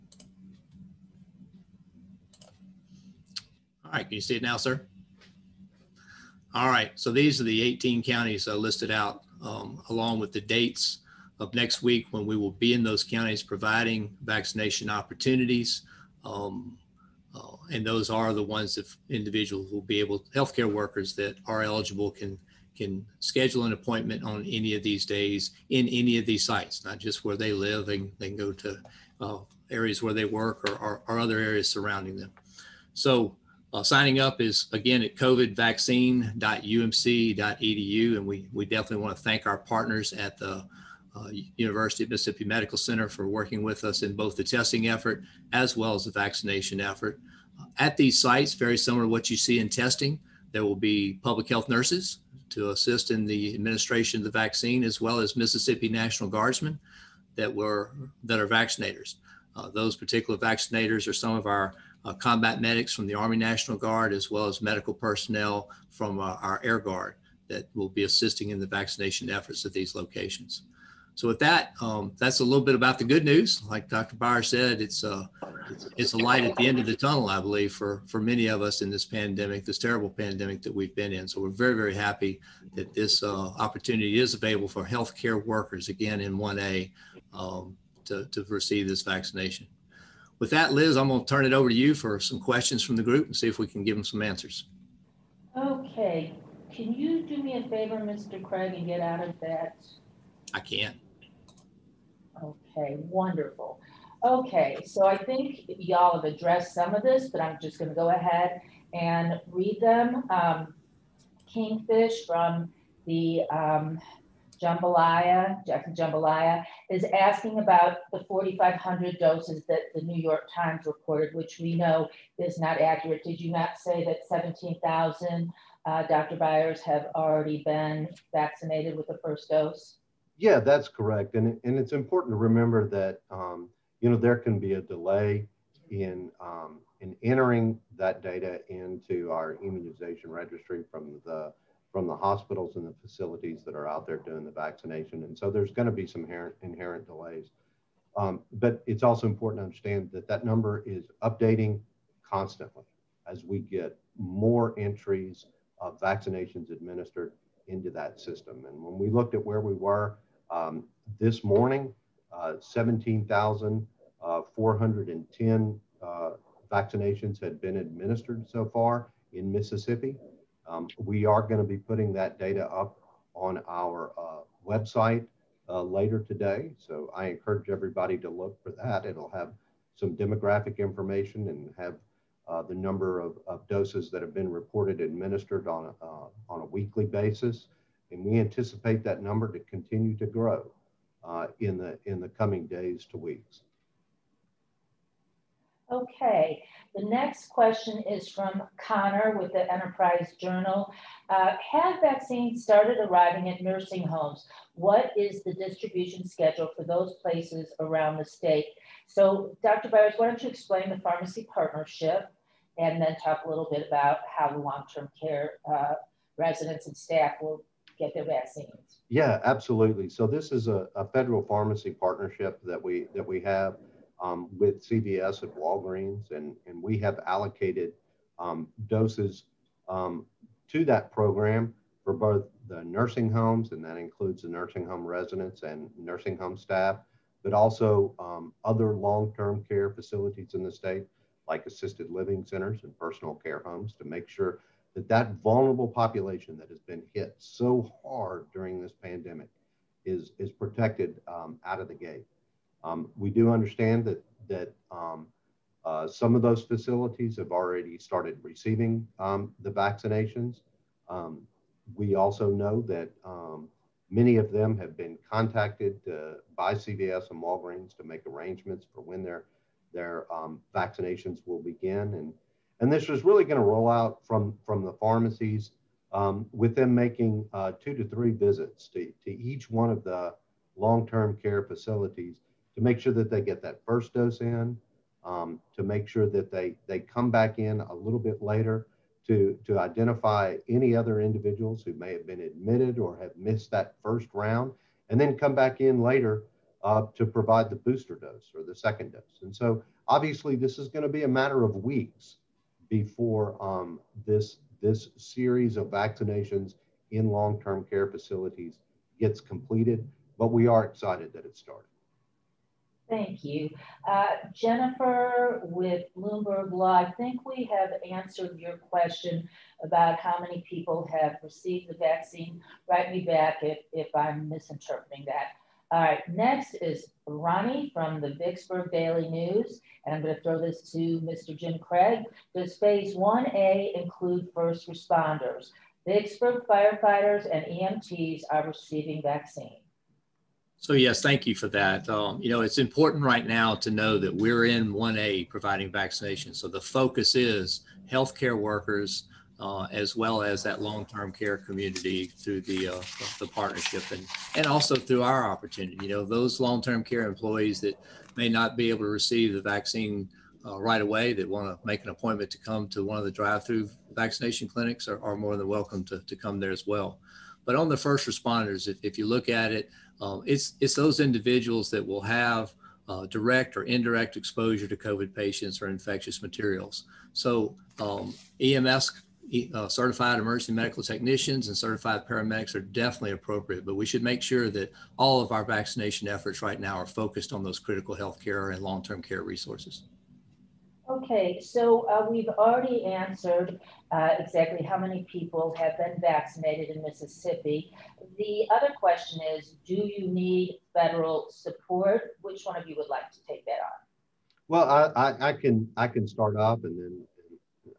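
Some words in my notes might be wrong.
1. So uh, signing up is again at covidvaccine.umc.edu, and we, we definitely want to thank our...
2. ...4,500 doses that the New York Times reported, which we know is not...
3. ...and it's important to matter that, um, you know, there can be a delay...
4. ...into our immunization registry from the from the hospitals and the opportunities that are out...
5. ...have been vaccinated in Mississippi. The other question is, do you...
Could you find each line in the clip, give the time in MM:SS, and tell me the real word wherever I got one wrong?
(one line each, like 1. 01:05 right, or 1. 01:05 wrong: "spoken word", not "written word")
1. 00:32 right
2. 01:58 right
3. 02:11 wrong: "remember", not "matter"
4. 02:18 wrong: "facilities", not "opportunities"
5. 06:35 right.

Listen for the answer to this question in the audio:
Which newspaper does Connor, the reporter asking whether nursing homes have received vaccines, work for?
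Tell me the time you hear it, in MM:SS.
03:19.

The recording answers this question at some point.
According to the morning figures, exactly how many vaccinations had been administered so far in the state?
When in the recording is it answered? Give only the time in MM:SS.
02:42.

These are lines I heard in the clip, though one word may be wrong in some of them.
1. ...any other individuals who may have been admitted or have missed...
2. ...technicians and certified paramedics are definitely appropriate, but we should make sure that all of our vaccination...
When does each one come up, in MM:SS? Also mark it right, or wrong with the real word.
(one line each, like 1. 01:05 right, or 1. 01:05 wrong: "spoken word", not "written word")
1. 04:50 right
2. 06:21 right.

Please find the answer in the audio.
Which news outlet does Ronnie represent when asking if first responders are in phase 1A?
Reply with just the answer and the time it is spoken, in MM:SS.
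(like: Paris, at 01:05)
Vicksburg Daily News, at 05:28.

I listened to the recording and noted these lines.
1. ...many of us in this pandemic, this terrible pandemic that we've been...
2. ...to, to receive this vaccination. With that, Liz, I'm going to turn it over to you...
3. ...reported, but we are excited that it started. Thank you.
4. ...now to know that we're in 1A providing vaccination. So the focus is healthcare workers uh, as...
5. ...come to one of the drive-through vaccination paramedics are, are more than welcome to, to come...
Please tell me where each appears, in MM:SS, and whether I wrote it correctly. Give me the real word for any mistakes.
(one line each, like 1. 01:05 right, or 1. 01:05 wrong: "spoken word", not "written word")
1. 01:18 right
2. 01:28 right
3. 05:09 wrong: "completed", not "reported"
4. 05:43 right
5. 06:02 wrong: "clinics", not "paramedics".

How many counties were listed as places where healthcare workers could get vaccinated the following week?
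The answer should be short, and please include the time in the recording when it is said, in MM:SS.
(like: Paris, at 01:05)
18, at 00:07.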